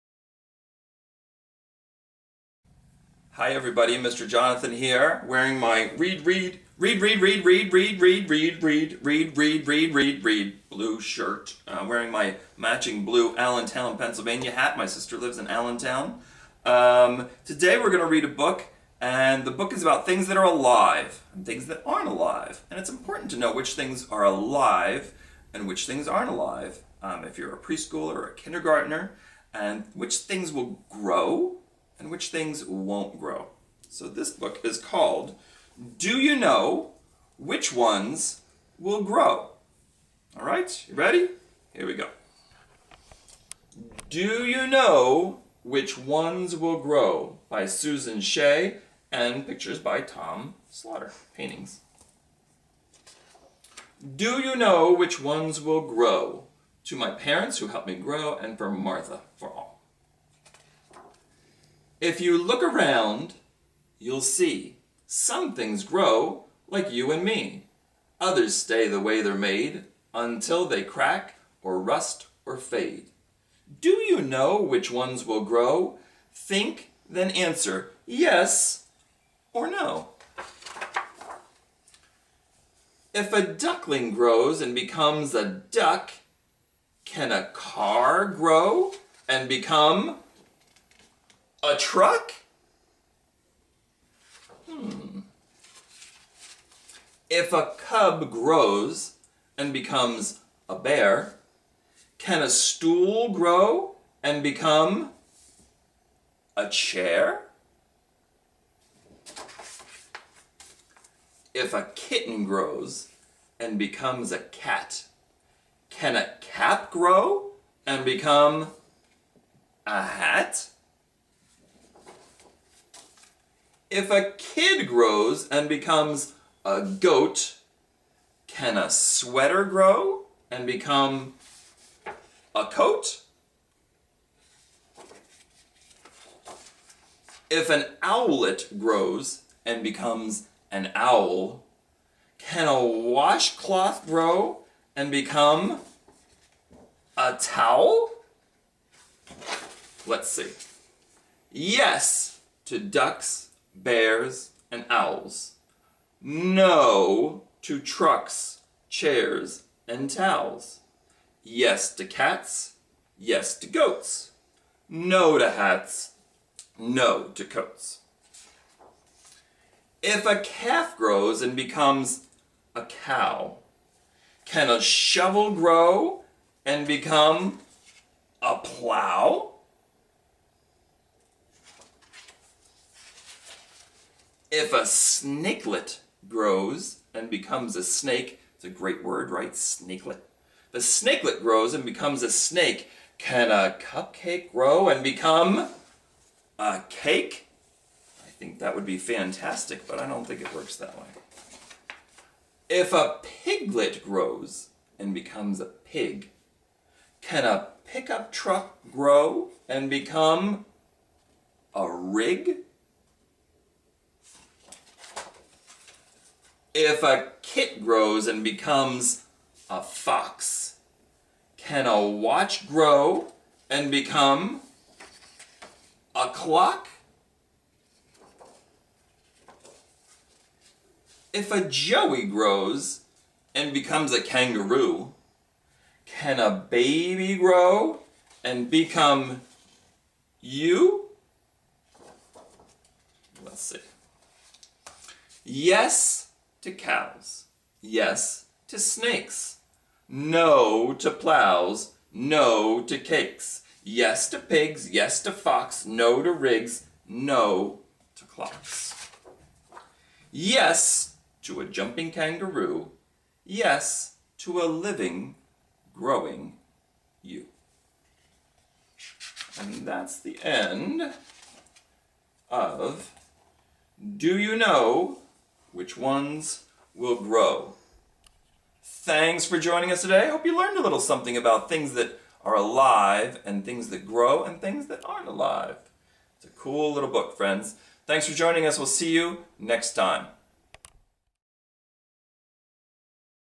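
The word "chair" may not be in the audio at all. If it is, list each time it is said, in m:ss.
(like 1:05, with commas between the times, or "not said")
1:46, 2:38.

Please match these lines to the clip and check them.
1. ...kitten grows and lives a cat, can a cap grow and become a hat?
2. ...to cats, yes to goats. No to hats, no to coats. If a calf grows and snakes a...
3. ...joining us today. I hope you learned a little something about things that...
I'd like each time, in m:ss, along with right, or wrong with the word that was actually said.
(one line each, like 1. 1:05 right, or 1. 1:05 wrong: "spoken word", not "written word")
1. 1:51 wrong: "becomes", not "lives"
2. 2:41 wrong: "becomes", not "snakes"
3. 4:39 right.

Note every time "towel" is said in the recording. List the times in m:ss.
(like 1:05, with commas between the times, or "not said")
2:27, 2:40.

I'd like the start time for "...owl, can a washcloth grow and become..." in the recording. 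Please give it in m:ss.
2:20.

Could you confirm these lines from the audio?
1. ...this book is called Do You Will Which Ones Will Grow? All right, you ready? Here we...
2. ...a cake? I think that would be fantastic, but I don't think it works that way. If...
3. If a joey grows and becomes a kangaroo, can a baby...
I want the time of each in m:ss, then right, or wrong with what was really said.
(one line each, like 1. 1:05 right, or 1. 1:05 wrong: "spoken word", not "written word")
1. 0:34 wrong: "Know", not "Will"
2. 3:16 right
3. 3:51 right.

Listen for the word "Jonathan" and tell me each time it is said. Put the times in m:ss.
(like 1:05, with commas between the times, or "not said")
0:04.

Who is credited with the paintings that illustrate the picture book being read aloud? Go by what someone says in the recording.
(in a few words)
Tom Slaughter.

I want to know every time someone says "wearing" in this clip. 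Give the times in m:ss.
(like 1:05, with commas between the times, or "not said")
0:05, 0:11.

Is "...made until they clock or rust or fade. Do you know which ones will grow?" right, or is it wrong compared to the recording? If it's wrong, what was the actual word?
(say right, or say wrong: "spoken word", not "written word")
wrong: "crack", not "clock".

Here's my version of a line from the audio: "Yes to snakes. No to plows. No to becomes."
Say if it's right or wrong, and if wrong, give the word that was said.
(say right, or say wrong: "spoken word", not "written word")
wrong: "cakes", not "becomes".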